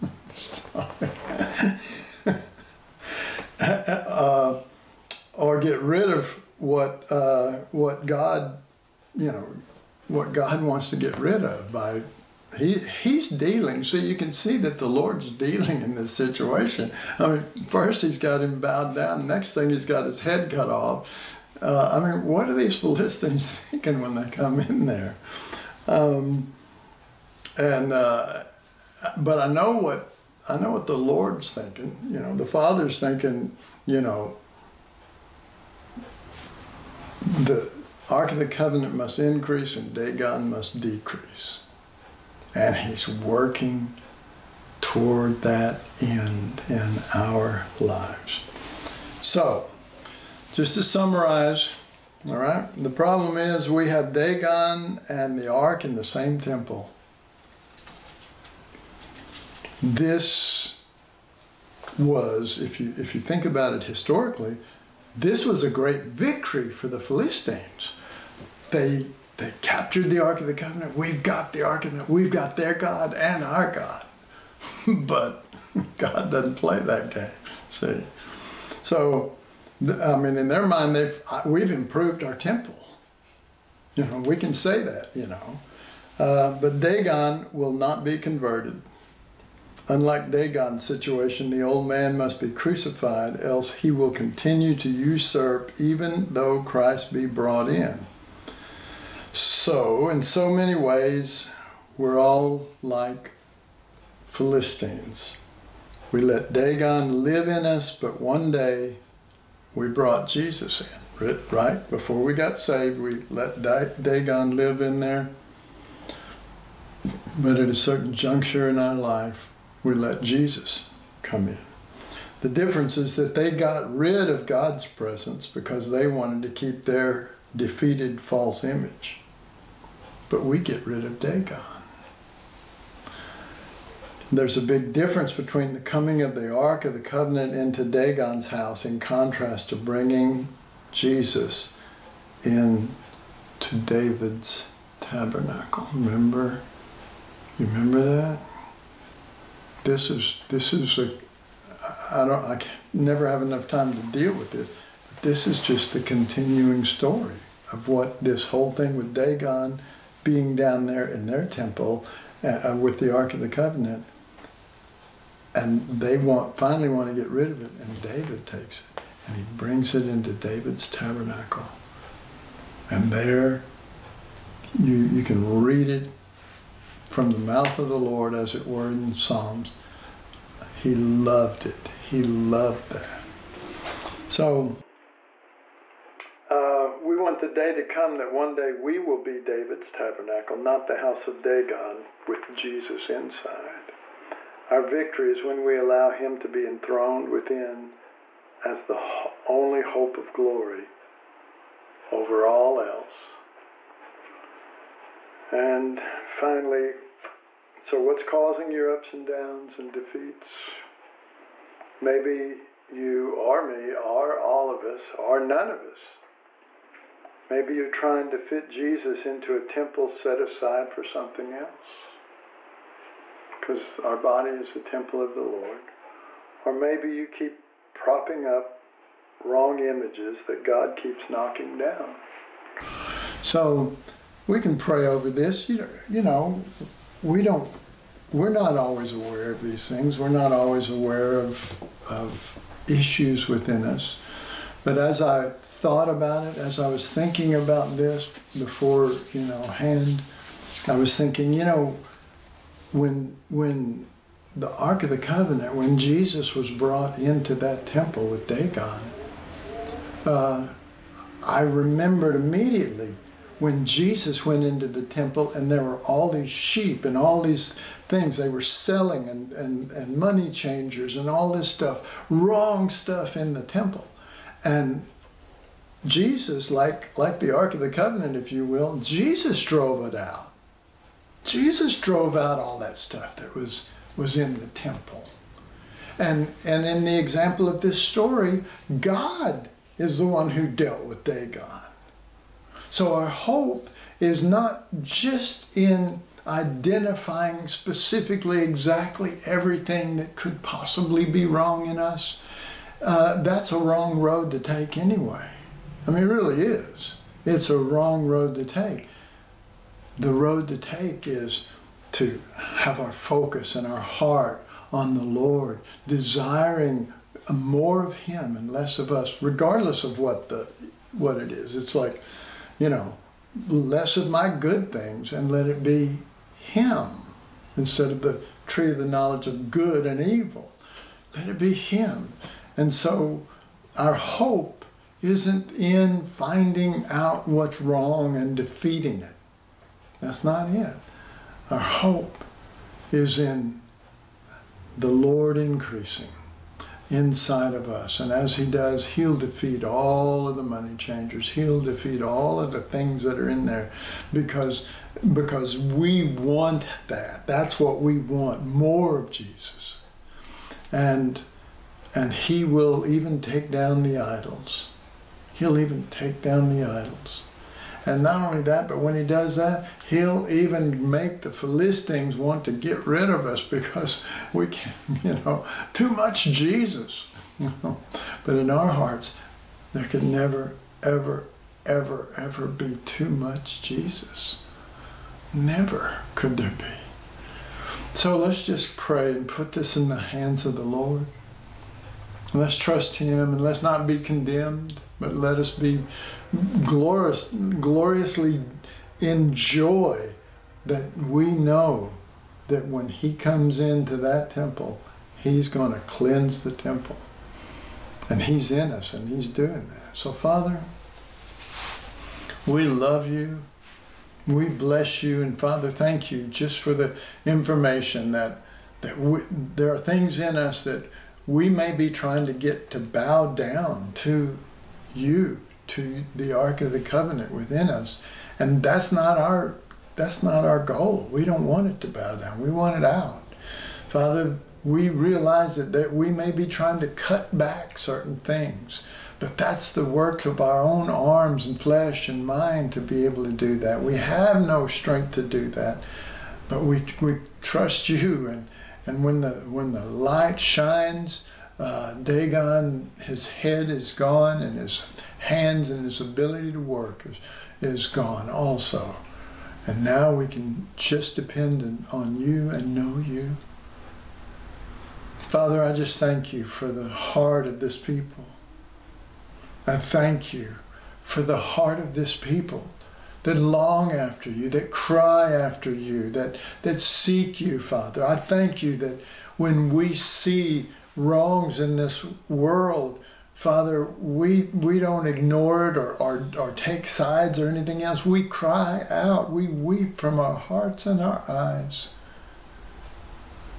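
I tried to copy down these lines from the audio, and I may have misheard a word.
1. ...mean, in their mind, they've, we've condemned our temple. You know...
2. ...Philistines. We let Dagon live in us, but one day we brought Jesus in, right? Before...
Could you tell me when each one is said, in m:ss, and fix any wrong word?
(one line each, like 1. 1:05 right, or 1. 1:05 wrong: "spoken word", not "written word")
1. 1:20 wrong: "improved", not "condemned"
2. 1:44 right.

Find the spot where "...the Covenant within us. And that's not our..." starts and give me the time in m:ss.
7:06.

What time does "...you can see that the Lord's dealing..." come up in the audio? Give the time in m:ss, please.
0:13.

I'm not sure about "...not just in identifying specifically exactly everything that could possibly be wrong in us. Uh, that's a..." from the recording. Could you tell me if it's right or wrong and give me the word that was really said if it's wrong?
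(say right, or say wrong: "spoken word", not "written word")
right.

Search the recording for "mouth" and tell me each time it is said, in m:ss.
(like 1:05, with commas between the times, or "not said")
2:57.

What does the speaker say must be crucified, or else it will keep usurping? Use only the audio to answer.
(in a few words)
The old man.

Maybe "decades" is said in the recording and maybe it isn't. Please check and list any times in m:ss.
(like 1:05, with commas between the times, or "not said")
not said.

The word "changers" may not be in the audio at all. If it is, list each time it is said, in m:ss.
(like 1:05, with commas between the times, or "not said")
4:30, 5:50.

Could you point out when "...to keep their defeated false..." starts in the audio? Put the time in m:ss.
2:06.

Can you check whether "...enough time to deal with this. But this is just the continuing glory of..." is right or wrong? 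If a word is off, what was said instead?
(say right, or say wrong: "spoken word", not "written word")
wrong: "story", not "glory".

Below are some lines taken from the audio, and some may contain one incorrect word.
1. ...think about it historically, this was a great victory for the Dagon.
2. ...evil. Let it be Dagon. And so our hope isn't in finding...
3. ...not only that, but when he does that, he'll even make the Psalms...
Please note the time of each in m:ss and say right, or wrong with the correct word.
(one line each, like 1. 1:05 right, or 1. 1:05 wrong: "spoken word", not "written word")
1. 1:03 wrong: "Philistines", not "Dagon"
2. 5:30 wrong: "Him", not "Dagon"
3. 6:08 wrong: "Philistines", not "Psalms".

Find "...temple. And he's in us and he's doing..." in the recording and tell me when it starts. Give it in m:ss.
6:46.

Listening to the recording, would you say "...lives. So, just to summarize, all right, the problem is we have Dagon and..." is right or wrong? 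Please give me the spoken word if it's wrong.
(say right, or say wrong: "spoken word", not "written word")
right.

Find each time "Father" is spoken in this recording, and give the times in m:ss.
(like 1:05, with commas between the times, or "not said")
0:32, 6:50, 6:55, 7:14, 7:45, 7:57, 8:03.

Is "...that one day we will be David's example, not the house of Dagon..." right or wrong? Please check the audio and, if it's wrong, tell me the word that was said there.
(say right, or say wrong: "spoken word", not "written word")
wrong: "tabernacle", not "example".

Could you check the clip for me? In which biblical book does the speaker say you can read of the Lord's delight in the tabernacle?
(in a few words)
Psalms.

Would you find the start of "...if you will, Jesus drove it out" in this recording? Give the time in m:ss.
4:38.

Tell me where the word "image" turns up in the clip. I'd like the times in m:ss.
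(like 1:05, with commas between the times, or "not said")
2:08, 3:49.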